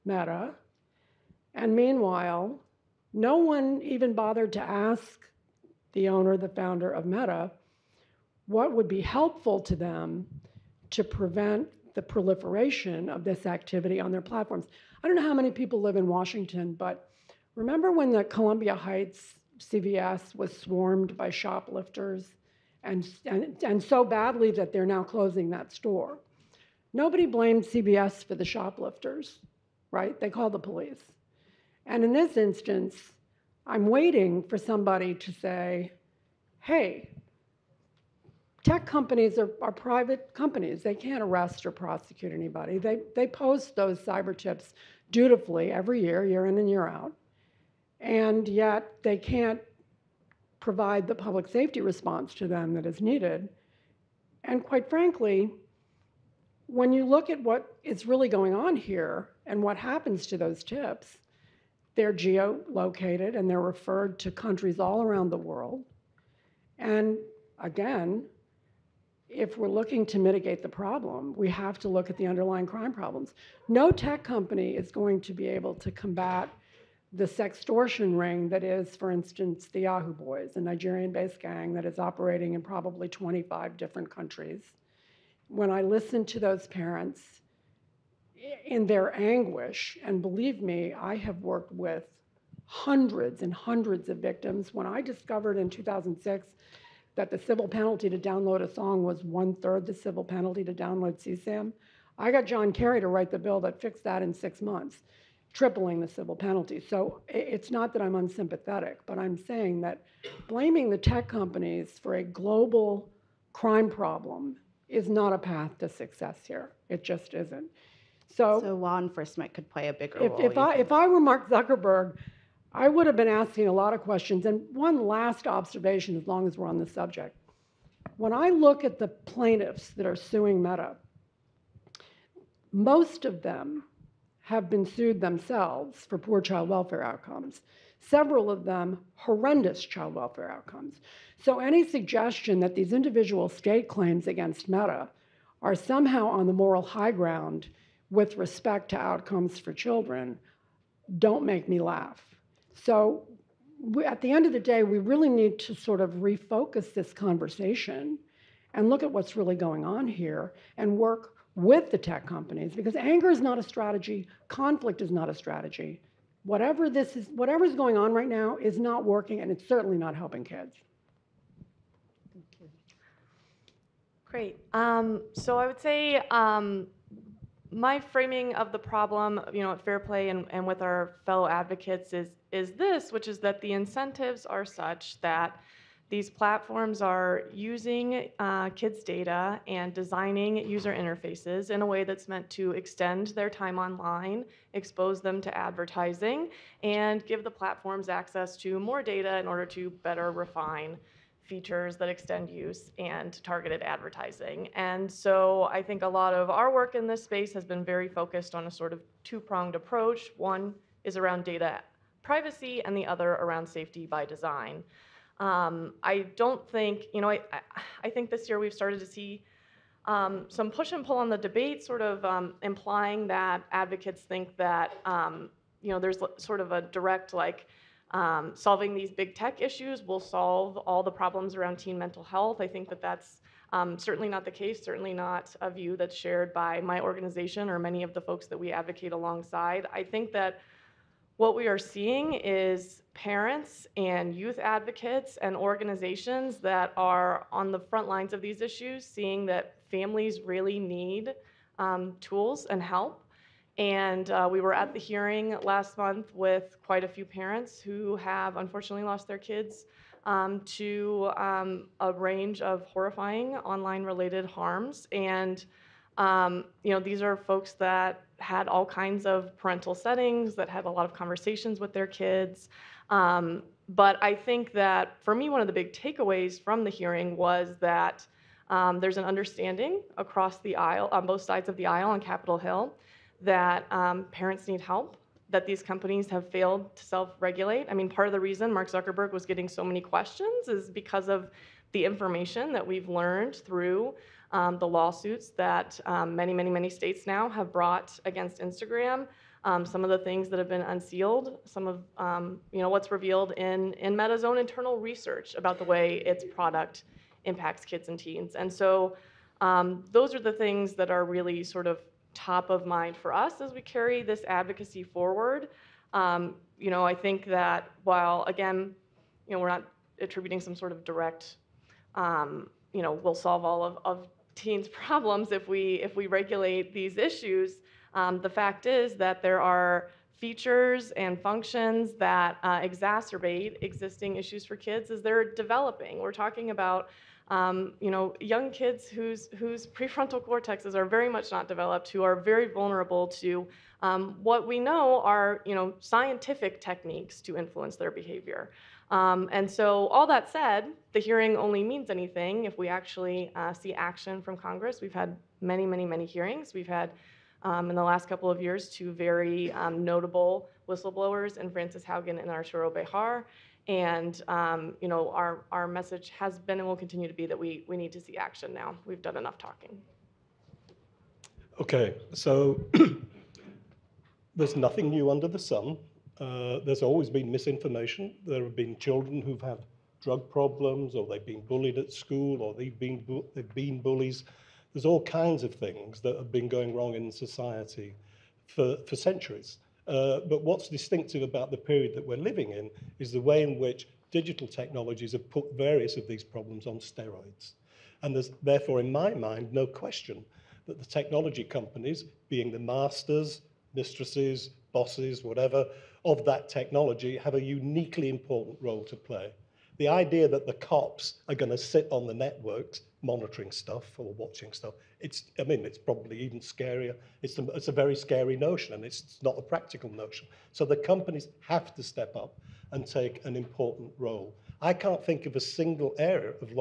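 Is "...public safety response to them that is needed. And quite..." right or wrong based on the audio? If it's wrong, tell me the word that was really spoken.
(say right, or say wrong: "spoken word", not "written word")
right.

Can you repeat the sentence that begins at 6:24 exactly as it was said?
There's all kinds of things that have been going wrong in society for, for centuries.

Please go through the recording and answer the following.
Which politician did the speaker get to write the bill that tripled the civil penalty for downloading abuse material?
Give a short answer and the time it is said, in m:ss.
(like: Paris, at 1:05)
John Kerry, at 1:42.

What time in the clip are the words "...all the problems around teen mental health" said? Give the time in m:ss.
3:50.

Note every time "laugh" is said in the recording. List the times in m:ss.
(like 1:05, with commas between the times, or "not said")
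2:31.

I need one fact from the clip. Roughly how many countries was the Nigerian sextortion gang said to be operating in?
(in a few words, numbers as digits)
25.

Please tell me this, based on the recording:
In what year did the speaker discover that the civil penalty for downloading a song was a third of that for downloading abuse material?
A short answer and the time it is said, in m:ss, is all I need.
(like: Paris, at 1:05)
2006, at 1:35.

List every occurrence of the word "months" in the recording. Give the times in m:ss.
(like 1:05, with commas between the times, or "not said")
1:44, 4:15.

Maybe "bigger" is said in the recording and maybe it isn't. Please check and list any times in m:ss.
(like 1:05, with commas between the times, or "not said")
1:59.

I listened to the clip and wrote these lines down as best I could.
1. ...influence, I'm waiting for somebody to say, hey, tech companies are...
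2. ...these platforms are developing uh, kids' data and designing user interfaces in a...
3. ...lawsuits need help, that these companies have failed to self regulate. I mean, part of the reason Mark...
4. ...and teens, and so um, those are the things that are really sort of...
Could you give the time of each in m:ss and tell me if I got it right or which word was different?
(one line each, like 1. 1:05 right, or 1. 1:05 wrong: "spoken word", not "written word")
1. 0:32 wrong: "instance", not "influence"
2. 3:06 wrong: "using", not "developing"
3. 4:44 wrong: "parents", not "lawsuits"
4. 5:08 right.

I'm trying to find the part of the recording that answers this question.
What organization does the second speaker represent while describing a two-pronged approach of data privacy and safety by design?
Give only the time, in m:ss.
2:59.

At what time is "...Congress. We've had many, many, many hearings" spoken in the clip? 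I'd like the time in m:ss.
5:54.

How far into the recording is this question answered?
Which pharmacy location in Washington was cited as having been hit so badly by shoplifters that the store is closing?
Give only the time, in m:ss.
0:18.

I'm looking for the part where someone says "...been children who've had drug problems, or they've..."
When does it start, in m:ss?
6:18.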